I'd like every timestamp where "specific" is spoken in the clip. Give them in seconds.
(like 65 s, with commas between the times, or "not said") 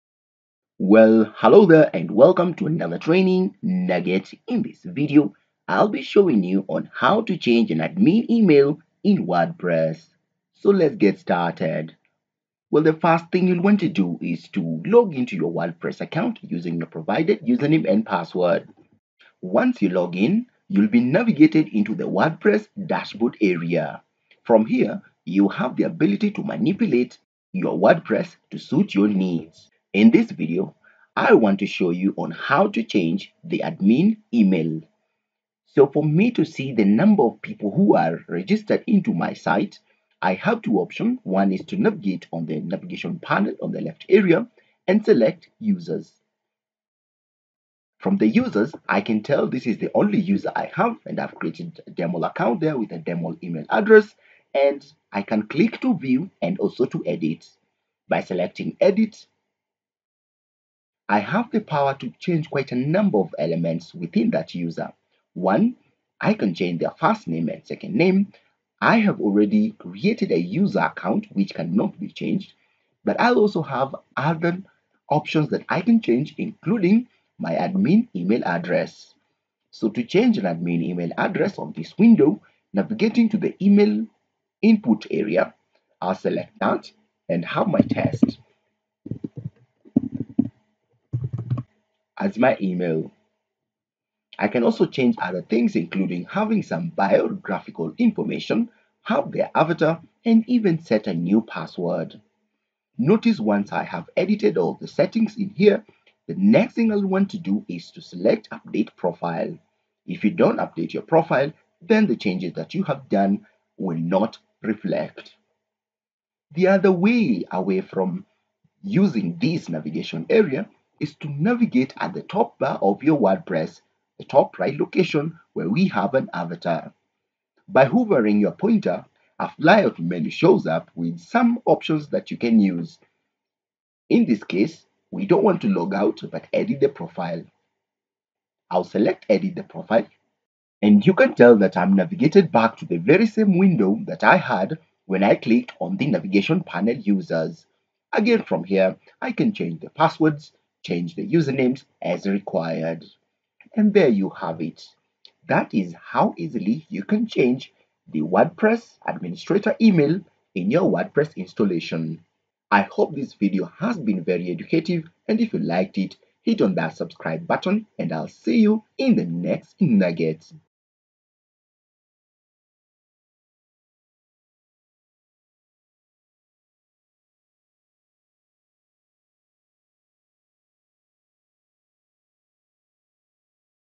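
not said.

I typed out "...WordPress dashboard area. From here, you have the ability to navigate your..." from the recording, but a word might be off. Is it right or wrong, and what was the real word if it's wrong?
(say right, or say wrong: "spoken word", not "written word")
wrong: "manipulate", not "navigate".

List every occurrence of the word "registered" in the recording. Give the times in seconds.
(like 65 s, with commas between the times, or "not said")
38 s.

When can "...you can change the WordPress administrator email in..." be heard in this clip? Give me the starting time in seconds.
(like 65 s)
156 s.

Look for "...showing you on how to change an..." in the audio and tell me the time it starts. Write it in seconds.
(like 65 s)
6 s.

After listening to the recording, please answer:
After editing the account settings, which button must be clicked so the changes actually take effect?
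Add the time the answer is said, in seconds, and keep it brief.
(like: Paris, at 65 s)
Update profile, at 108 s.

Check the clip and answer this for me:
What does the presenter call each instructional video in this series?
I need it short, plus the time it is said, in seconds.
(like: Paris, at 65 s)
Training nugget, at 2 s.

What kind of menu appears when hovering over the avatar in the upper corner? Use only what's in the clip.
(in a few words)
A flyout menu.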